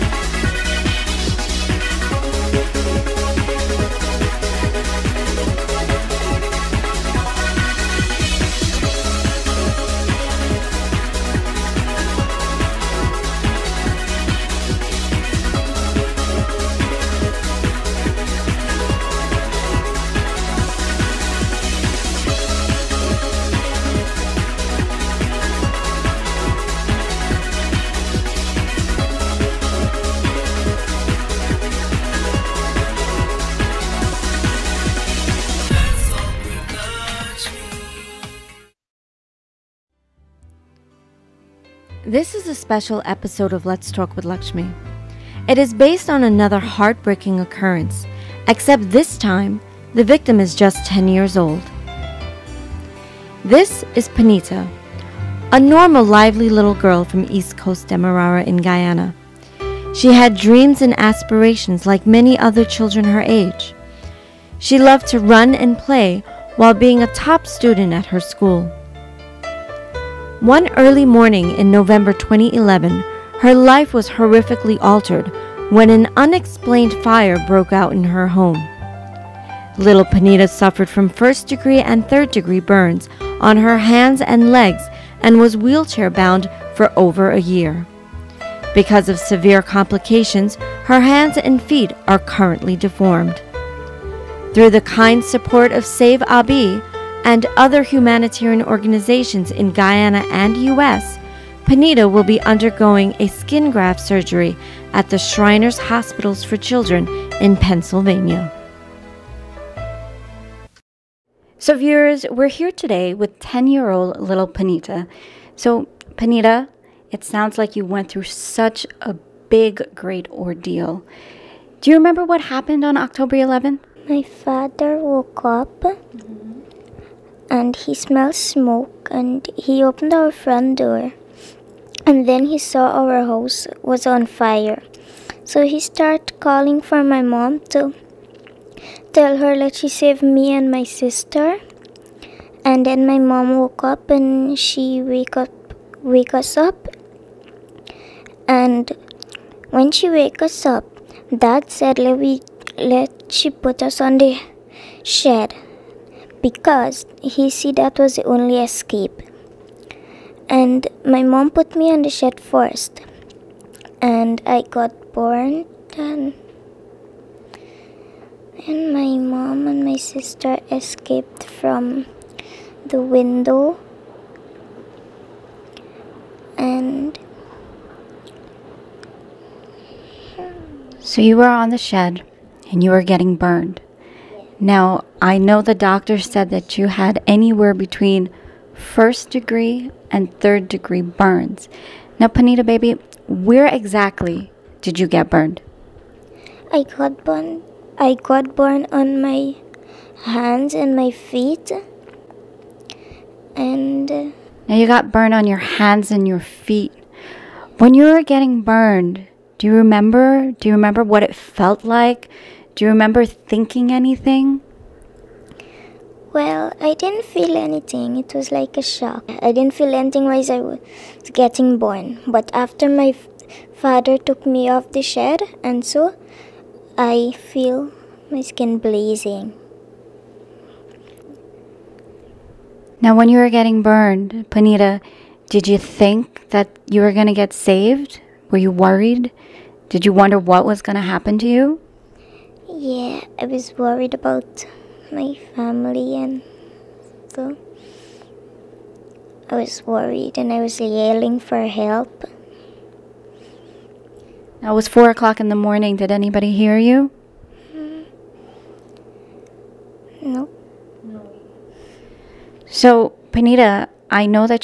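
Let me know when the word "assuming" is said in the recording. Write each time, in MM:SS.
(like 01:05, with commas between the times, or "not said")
not said.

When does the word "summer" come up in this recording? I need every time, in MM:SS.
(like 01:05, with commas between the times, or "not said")
not said.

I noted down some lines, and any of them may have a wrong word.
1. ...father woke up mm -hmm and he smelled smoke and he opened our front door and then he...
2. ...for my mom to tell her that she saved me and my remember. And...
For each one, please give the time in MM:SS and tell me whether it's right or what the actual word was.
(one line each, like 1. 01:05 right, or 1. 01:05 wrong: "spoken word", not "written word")
1. 02:04 right
2. 02:16 wrong: "sister", not "remember".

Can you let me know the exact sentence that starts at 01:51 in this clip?
So, viewers, we're here today with 10 year old little Punita.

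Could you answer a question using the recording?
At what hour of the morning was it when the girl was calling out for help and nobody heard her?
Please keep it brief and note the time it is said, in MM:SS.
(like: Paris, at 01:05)
4 o'clock, at 04:14.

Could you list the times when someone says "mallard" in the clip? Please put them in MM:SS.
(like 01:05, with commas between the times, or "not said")
not said.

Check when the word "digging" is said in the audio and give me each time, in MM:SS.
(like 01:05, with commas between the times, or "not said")
not said.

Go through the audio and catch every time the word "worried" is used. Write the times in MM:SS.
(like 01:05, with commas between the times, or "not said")
03:58, 04:03, 04:09.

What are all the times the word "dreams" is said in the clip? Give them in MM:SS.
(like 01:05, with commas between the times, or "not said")
01:00.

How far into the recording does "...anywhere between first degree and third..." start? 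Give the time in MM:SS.
03:07.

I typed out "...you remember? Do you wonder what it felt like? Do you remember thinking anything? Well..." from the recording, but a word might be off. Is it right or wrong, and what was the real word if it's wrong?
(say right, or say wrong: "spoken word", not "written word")
wrong: "remember", not "wonder".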